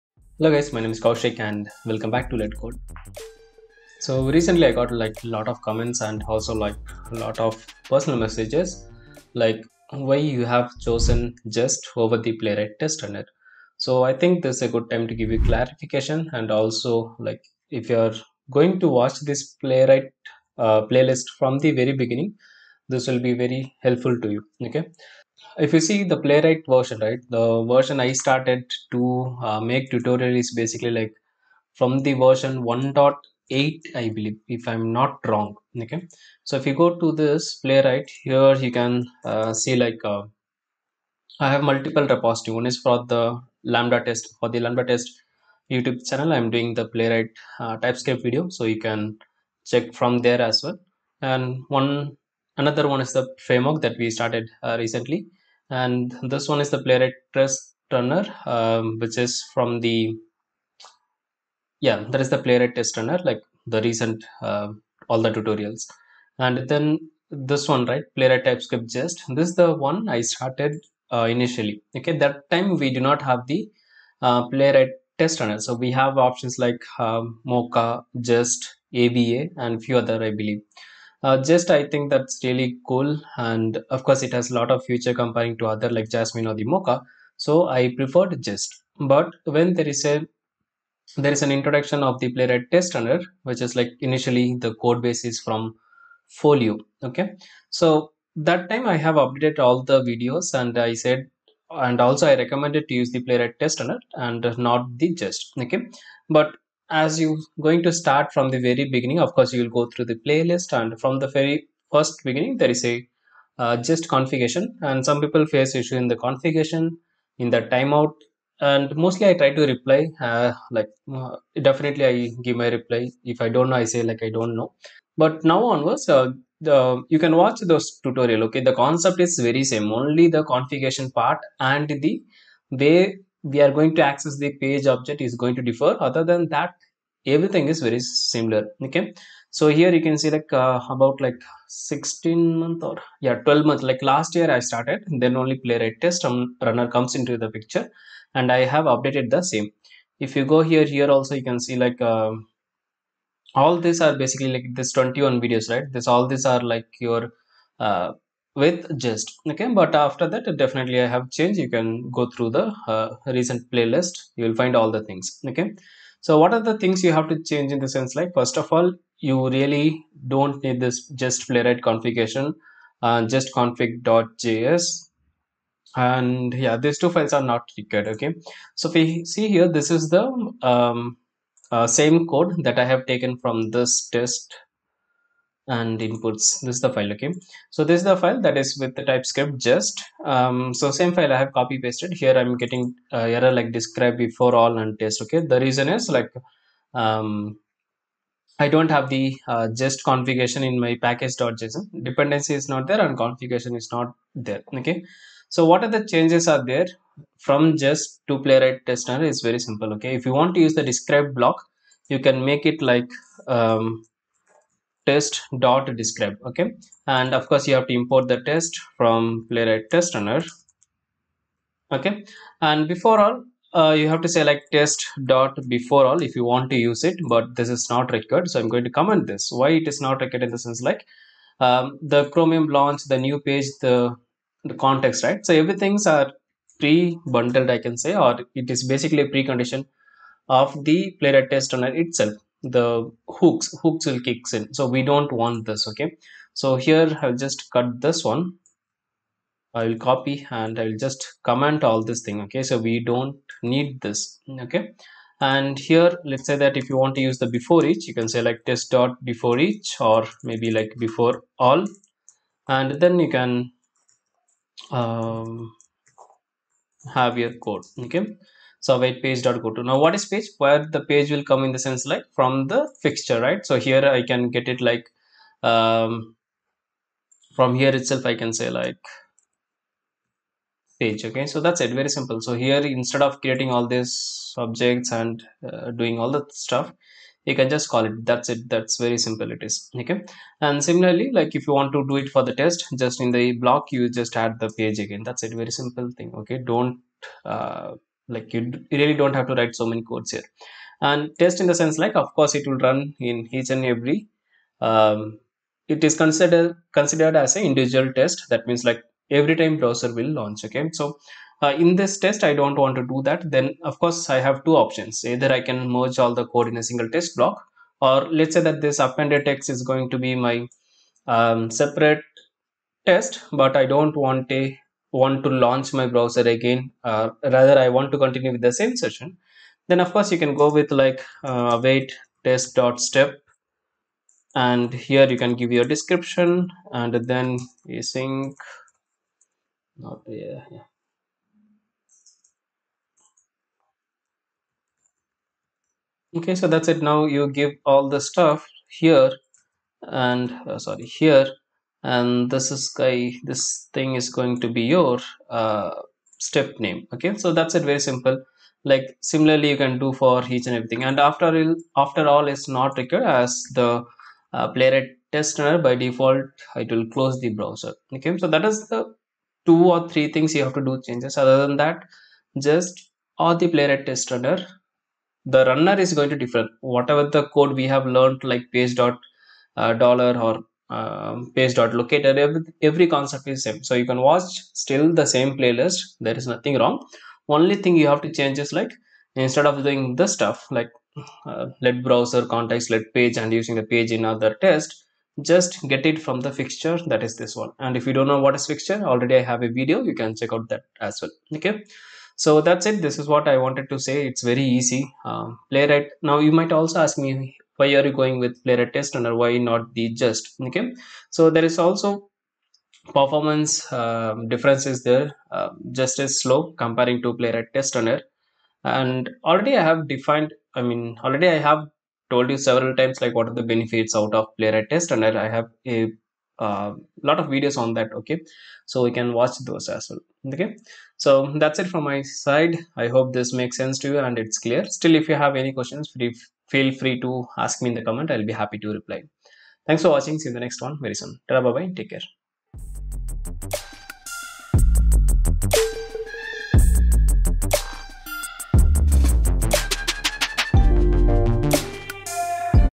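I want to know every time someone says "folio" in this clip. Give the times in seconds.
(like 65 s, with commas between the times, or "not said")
96 s.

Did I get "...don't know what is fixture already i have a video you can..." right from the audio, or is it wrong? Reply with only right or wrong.
right.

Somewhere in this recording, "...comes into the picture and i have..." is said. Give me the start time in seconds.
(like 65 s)
146 s.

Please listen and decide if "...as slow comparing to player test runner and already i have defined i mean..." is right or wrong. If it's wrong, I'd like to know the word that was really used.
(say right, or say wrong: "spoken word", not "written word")
right.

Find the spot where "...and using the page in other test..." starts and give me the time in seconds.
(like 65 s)
393 s.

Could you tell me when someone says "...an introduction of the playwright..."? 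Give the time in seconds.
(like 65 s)
91 s.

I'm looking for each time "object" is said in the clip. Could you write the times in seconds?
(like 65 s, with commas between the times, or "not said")
134 s, 284 s.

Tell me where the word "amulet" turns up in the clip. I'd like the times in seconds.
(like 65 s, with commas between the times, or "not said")
not said.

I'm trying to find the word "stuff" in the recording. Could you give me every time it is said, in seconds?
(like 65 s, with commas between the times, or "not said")
286 s, 348 s, 390 s.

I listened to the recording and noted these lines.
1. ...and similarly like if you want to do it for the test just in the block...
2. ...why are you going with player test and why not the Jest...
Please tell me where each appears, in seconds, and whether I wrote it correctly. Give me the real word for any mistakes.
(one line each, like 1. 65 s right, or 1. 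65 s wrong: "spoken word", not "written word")
1. 290 s right
2. 407 s right.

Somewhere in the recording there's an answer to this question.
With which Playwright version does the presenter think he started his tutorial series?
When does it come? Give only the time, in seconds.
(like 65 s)
32 s.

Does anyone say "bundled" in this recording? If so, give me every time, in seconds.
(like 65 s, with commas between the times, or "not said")
236 s.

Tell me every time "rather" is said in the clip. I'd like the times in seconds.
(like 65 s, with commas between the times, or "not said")
327 s.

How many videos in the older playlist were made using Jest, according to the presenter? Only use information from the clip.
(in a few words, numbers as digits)
21.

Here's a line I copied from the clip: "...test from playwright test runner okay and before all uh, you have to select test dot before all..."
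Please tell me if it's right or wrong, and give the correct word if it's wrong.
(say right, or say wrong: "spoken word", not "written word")
right.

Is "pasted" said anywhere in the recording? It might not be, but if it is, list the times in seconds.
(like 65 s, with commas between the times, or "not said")
191 s.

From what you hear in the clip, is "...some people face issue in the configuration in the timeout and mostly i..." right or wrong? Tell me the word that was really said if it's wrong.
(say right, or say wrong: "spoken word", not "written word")
right.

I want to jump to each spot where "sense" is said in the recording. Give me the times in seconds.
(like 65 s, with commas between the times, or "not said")
167 s, 230 s, 271 s, 301 s, 433 s.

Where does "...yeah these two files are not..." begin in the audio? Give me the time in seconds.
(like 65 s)
176 s.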